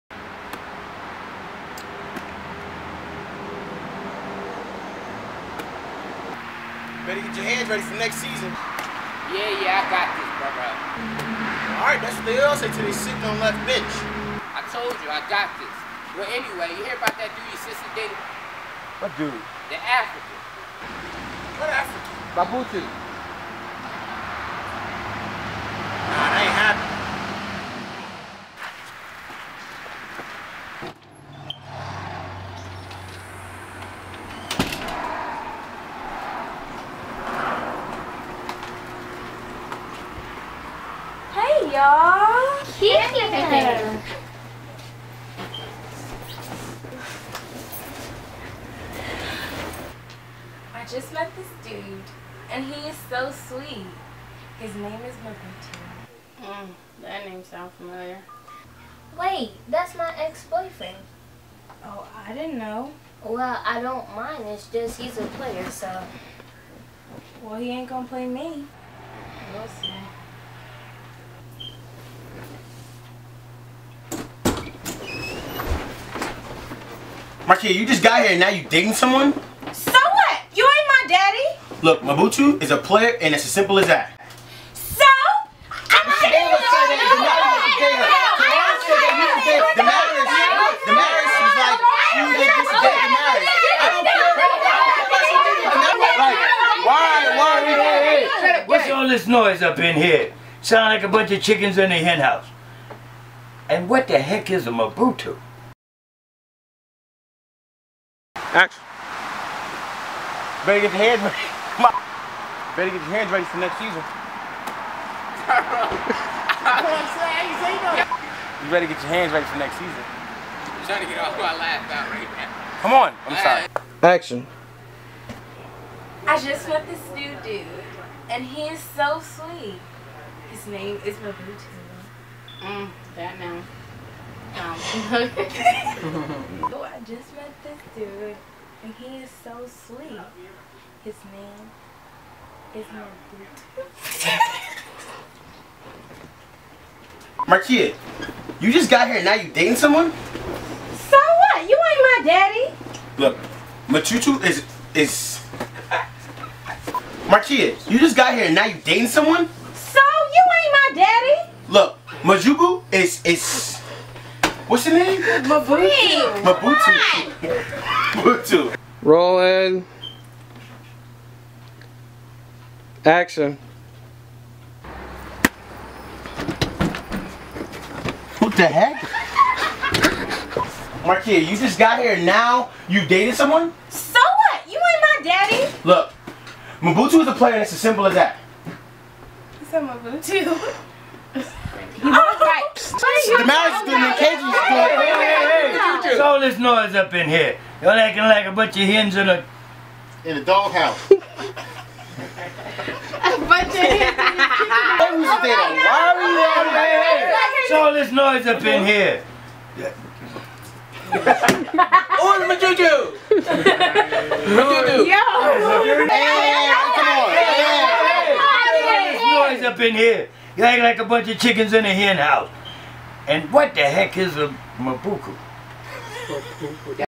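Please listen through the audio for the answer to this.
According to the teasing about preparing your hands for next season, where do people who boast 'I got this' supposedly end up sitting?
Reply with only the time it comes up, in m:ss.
0:13.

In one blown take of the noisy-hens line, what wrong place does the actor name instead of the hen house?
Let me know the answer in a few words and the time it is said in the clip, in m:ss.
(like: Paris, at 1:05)
doghouse, at 3:20.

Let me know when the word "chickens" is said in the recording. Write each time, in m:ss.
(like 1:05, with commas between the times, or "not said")
1:41, 3:41.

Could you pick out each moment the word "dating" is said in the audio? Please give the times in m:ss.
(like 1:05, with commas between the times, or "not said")
1:18, 1:26, 2:29, 2:38.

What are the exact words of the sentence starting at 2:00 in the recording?
I'm trying to get my out right now.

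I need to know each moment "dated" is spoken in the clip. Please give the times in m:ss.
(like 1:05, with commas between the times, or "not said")
0:17, 3:03.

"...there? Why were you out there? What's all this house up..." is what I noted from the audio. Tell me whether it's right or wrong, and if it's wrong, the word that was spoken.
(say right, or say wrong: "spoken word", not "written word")
wrong: "noise", not "house".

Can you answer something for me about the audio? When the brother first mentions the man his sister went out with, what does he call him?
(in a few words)
Babutu.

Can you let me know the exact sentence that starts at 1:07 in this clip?
Well, he ain't gonna play me.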